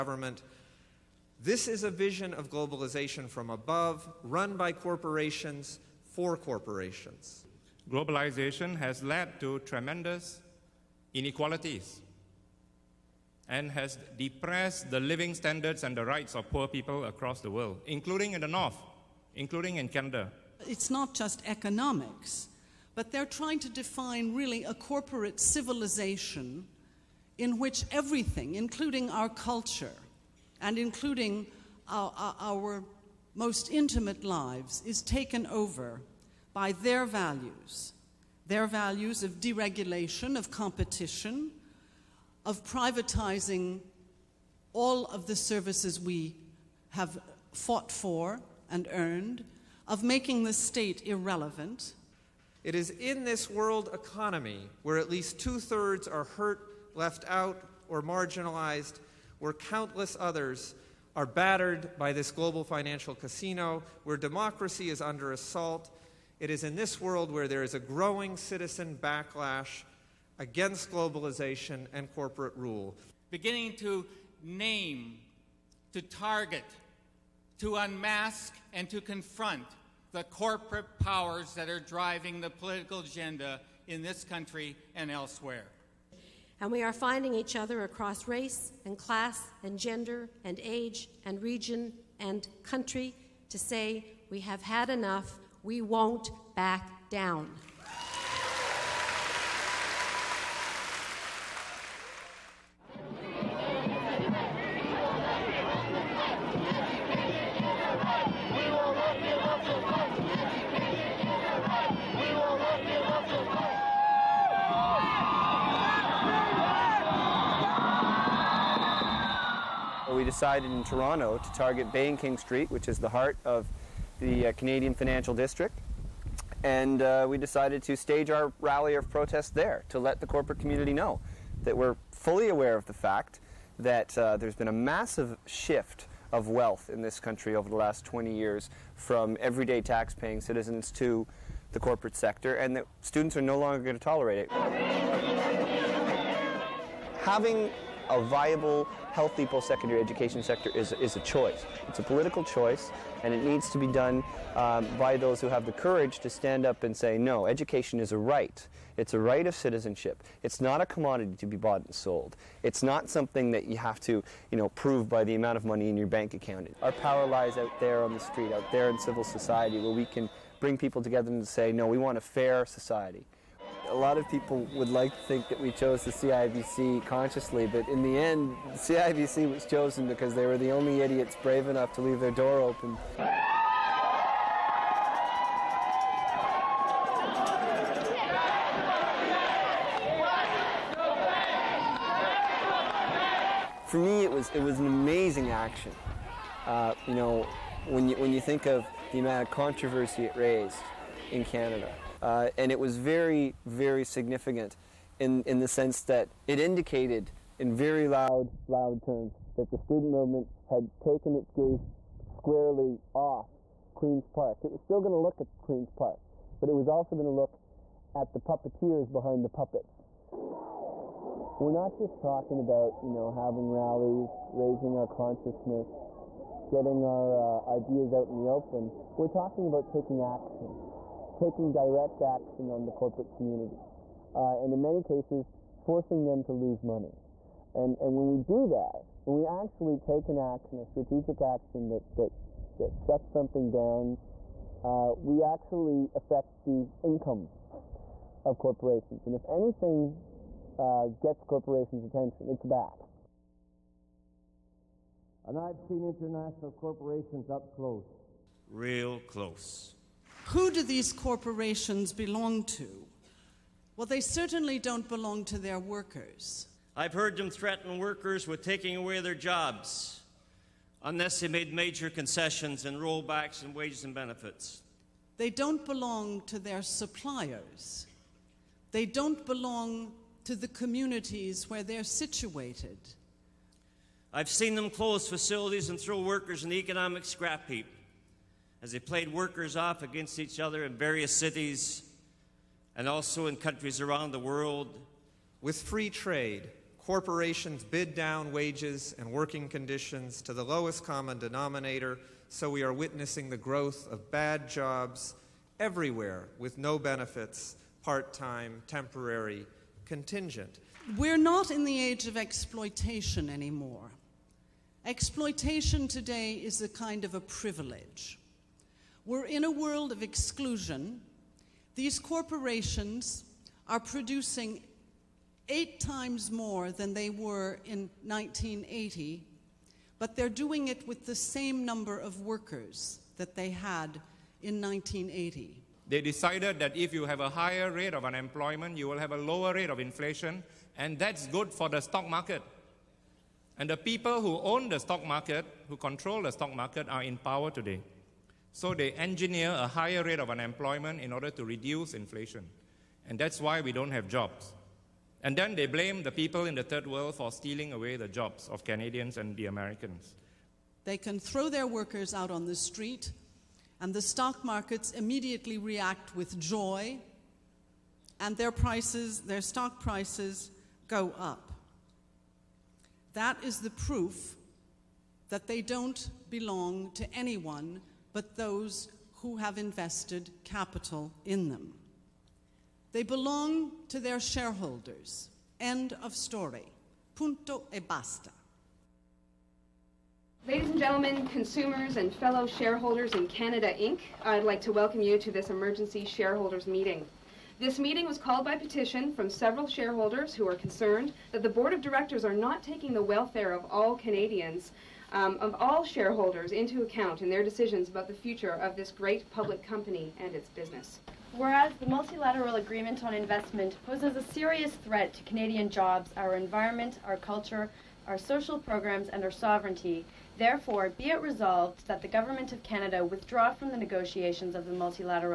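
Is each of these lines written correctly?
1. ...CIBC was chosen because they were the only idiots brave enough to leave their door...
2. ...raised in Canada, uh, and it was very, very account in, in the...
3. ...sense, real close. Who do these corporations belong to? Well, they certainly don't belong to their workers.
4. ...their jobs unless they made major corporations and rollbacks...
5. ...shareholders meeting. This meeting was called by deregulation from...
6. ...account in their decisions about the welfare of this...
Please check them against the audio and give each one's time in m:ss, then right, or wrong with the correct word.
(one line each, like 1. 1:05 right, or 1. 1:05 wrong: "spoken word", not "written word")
1. 2:58 right
2. 3:20 wrong: "significant", not "account"
3. 4:17 wrong: "close", not "sense"
4. 4:29 wrong: "concessions", not "corporations"
5. 6:36 wrong: "petition", not "deregulation"
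6. 6:47 wrong: "future", not "welfare".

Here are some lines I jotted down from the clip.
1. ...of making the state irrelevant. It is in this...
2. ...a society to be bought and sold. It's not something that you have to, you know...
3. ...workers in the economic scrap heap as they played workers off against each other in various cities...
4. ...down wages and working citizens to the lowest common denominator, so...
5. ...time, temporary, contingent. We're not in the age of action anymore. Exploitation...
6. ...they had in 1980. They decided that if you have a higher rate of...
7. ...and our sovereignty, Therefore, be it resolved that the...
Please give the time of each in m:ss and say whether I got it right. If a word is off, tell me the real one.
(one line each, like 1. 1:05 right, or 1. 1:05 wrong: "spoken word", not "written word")
1. 0:49 right
2. 2:40 wrong: "commodity", not "society"
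3. 4:46 right
4. 4:58 wrong: "conditions", not "citizens"
5. 5:08 wrong: "exploitation", not "action"
6. 5:33 right
7. 6:59 right.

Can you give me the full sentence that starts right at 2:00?
decided in Toronto to target Bay and King Street, which is the heart of the uh, Canadian Financial District.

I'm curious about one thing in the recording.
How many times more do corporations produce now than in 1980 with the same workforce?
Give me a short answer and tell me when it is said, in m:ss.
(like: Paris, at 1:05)
8 times, at 5:25.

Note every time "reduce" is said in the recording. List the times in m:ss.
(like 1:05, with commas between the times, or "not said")
5:51.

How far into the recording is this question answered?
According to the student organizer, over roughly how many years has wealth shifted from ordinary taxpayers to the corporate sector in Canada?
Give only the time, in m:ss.
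2:18.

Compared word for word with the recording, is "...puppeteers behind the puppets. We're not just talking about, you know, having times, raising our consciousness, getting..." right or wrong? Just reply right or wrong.
wrong.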